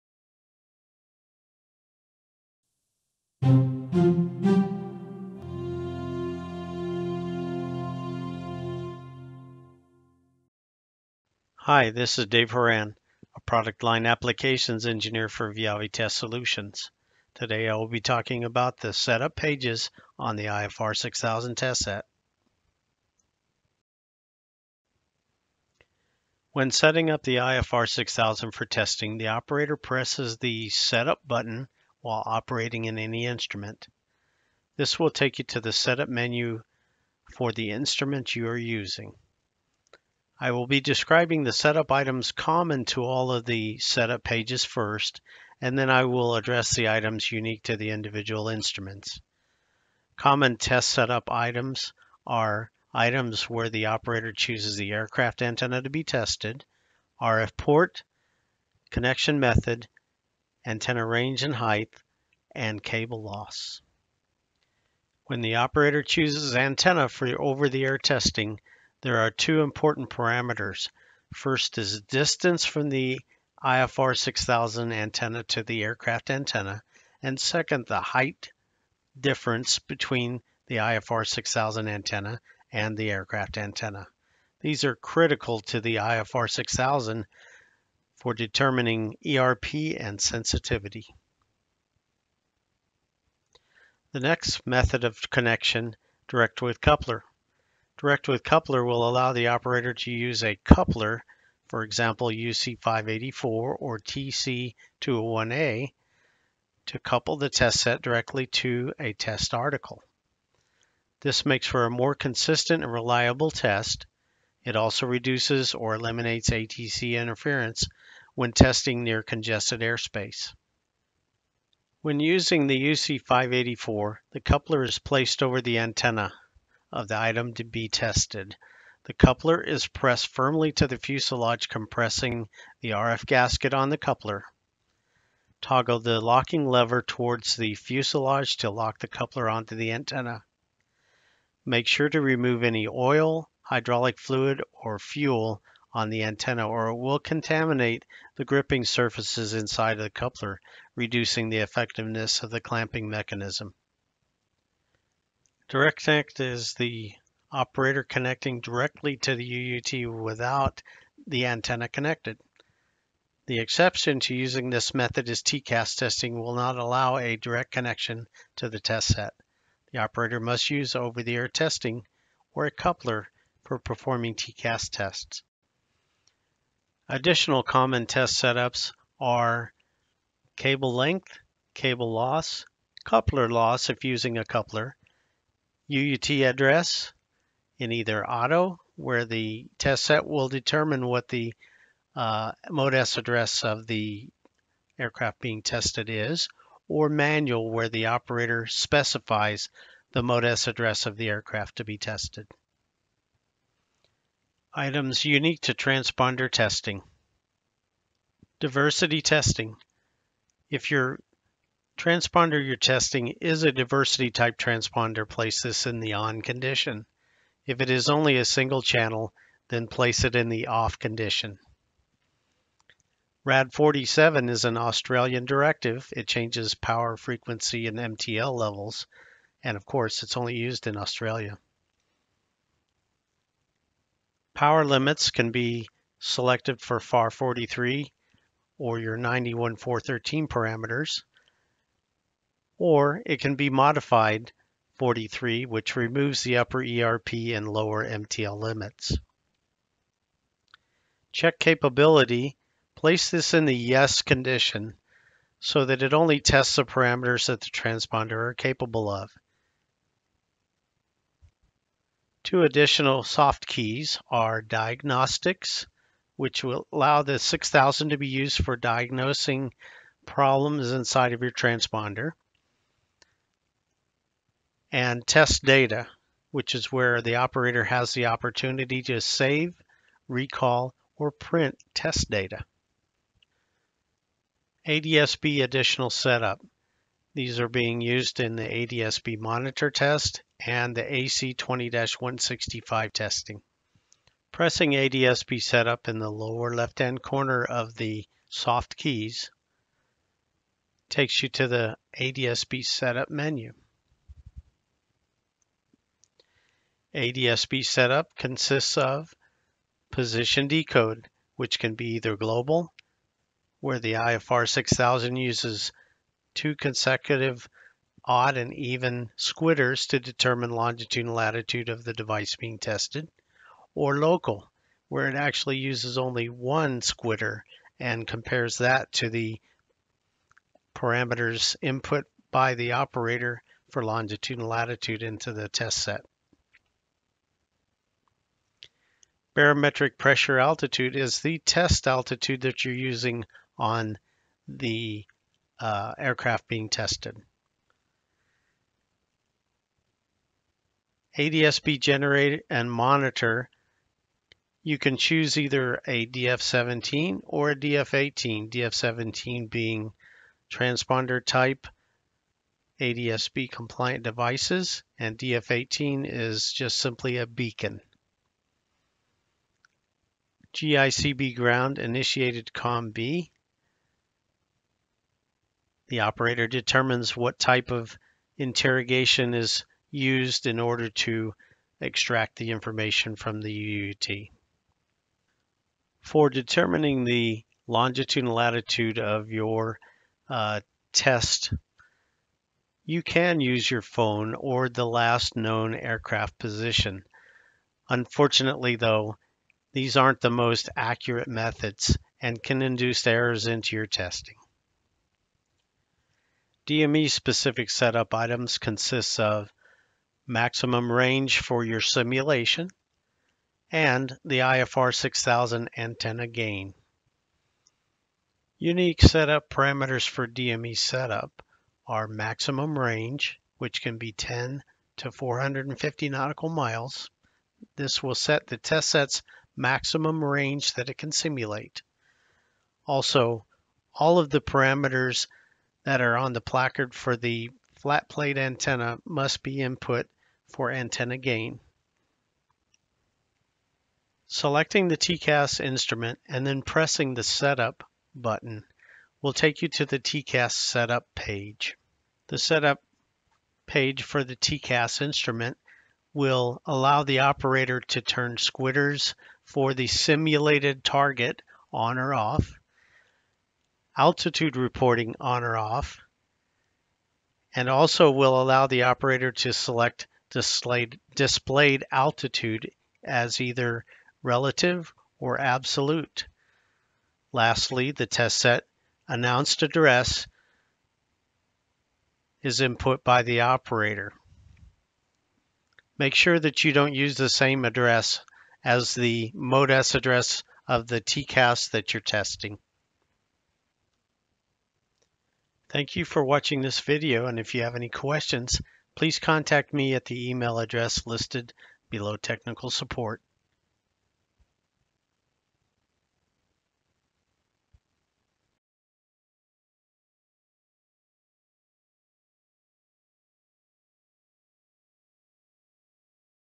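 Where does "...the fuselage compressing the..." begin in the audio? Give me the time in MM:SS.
02:10.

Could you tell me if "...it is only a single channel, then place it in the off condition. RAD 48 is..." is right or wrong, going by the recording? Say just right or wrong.
wrong.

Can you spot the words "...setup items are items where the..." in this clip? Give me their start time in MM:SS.
00:50.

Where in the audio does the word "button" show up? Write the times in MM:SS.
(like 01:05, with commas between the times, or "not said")
00:31, 07:28.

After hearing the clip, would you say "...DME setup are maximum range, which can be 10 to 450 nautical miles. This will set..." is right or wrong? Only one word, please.
right.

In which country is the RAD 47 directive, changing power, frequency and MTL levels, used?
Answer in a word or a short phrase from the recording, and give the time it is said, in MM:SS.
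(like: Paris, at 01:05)
Australia, at 03:50.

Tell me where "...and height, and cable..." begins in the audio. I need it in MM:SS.
01:01.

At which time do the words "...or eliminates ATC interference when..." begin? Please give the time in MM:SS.
01:55.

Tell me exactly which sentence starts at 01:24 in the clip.
These are critical to the IFR 6000 for determining ERP and sensitivity.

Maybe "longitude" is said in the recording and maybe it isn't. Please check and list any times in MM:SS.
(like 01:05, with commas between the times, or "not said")
05:20, 05:34, 06:27.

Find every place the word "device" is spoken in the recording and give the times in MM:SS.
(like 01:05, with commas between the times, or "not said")
05:22, 06:04.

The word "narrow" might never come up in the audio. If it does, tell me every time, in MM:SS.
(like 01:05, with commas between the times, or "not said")
not said.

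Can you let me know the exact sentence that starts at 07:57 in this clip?
Lastly, the test set announced address is input by the operator.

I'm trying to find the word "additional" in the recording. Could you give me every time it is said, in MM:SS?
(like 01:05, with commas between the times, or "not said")
02:57, 04:22, 04:45.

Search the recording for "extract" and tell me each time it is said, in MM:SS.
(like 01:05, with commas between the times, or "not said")
06:22.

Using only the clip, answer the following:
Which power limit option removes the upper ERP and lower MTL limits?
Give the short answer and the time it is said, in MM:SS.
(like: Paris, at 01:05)
modified 43, at 04:03.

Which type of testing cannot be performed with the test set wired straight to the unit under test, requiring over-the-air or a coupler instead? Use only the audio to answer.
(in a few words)
TCAS testing.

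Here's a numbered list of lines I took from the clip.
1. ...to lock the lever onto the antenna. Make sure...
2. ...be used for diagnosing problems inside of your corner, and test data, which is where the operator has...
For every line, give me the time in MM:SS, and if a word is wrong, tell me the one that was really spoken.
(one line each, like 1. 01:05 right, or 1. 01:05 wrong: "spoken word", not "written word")
1. 02:18 wrong: "coupler", not "lever"
2. 04:28 wrong: "transponder", not "corner".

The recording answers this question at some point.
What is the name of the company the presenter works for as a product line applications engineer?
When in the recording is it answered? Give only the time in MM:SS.
00:15.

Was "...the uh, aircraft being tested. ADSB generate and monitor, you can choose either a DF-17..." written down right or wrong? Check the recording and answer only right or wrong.
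right.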